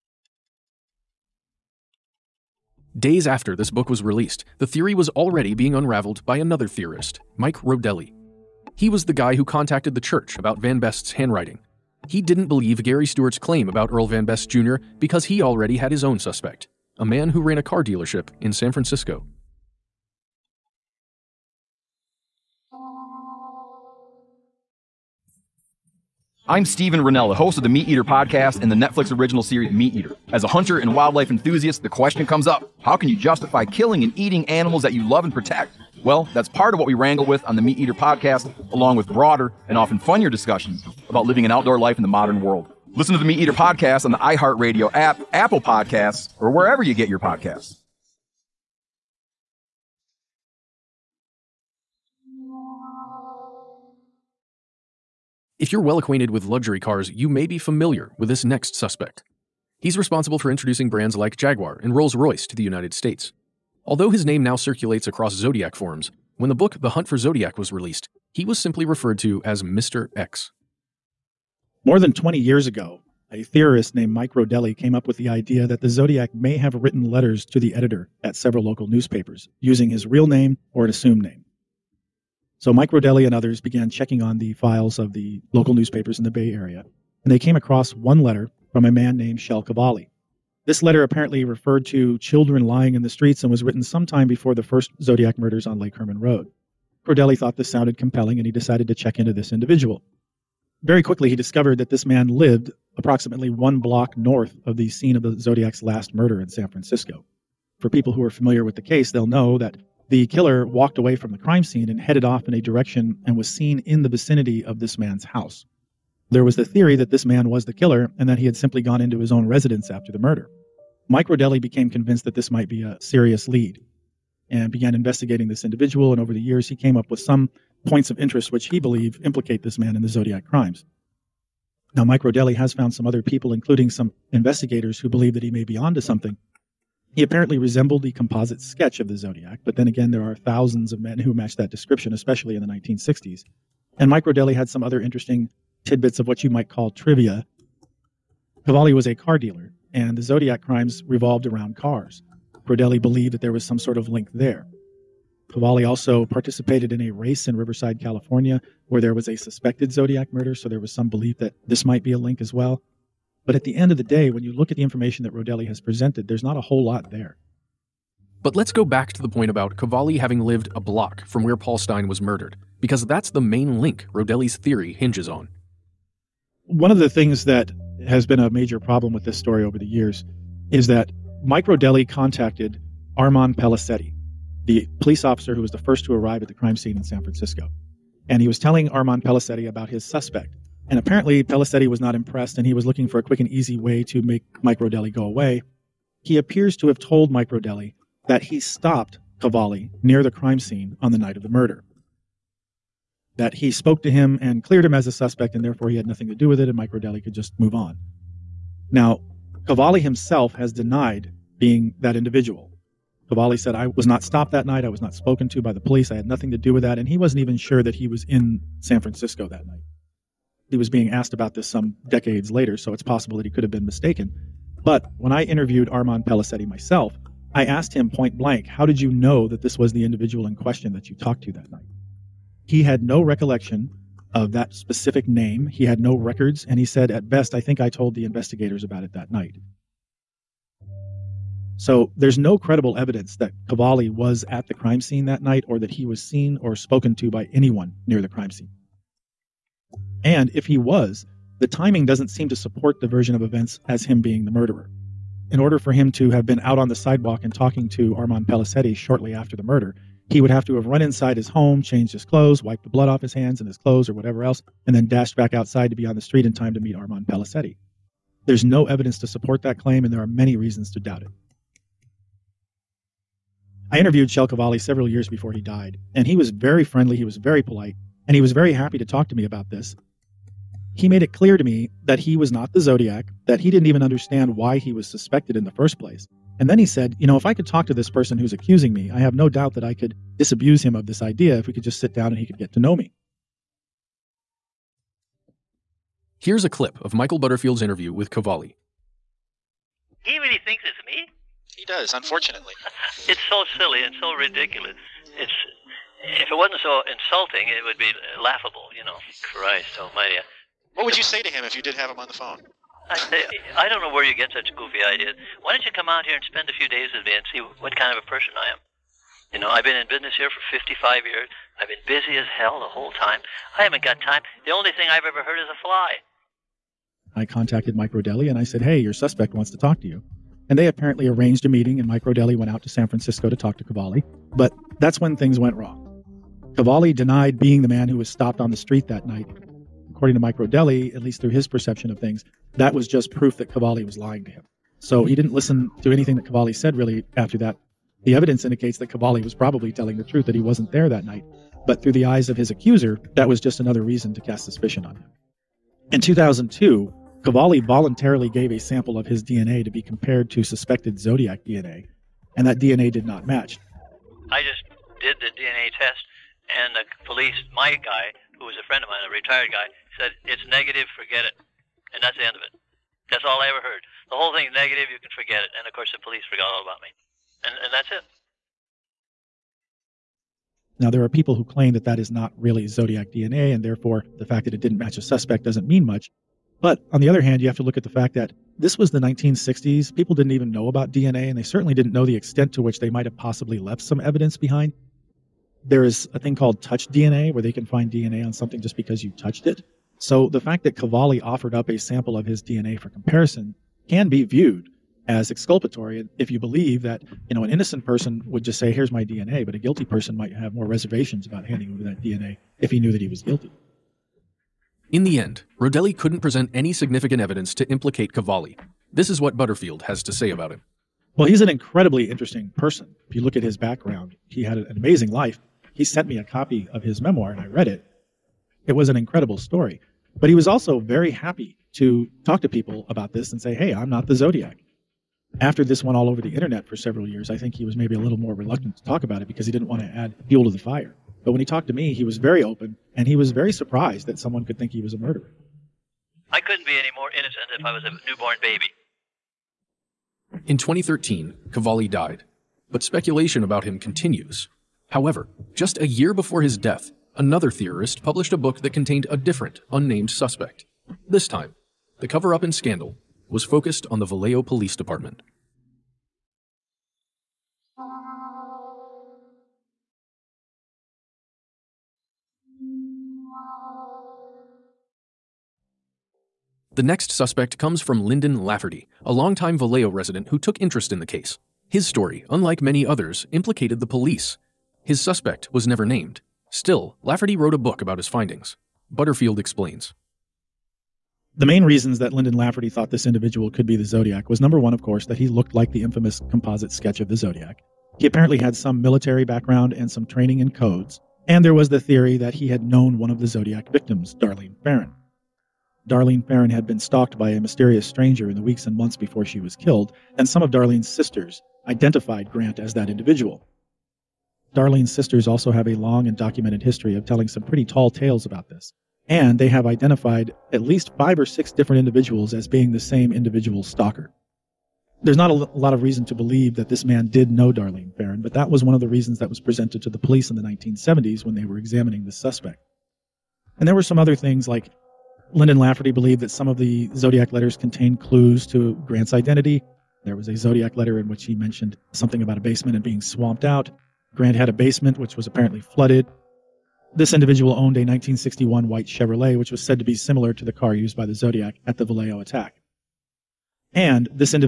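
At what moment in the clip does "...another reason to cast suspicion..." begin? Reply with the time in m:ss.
5:53.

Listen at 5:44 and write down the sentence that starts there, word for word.
So he didn't listen to anything that Qvale said really after that.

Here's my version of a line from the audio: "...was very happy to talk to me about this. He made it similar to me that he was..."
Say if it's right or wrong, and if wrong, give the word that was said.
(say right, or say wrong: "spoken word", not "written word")
wrong: "clear", not "similar".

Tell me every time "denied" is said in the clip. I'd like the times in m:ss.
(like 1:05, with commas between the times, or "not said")
3:30, 5:37.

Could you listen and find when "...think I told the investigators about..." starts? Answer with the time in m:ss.
3:57.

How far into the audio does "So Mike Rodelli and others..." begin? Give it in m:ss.
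1:22.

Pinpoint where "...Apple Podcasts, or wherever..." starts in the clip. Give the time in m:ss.
0:45.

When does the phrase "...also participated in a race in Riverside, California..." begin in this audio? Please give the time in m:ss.
2:35.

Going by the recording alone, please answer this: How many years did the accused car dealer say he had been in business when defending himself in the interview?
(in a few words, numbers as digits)
55.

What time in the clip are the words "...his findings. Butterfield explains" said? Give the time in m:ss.
8:08.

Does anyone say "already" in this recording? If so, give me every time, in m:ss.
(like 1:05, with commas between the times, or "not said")
0:05, 0:15.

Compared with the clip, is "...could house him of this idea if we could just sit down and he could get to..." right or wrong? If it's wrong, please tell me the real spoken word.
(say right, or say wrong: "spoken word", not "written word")
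wrong: "disabuse", not "house".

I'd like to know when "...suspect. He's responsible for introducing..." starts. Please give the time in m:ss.
0:58.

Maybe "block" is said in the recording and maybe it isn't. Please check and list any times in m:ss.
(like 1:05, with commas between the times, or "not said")
1:43, 2:50.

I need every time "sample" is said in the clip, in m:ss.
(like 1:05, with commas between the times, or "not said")
5:58, 6:41.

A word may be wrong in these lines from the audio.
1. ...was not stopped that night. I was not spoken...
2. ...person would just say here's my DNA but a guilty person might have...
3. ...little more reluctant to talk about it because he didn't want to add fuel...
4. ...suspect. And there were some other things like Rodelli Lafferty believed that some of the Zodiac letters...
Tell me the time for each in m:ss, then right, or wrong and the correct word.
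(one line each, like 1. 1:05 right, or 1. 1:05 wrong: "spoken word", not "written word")
1. 3:33 right
2. 6:48 right
3. 7:18 right
4. 8:52 wrong: "Lyndon", not "Rodelli".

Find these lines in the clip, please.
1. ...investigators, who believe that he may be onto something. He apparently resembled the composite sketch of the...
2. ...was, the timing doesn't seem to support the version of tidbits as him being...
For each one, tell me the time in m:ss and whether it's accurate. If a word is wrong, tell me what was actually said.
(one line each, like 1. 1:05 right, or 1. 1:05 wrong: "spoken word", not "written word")
1. 2:14 right
2. 4:10 wrong: "events", not "tidbits".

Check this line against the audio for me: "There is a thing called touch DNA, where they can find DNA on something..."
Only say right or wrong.
right.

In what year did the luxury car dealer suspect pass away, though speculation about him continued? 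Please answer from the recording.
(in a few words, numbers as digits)
2013.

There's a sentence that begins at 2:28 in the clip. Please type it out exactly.
Qvale was a car dealer, and the Zodiac crimes revolved around cars.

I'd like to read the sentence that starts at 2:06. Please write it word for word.
And over the years, he came up with some points of interest which he believed implicate this man in the Zodiac crimes.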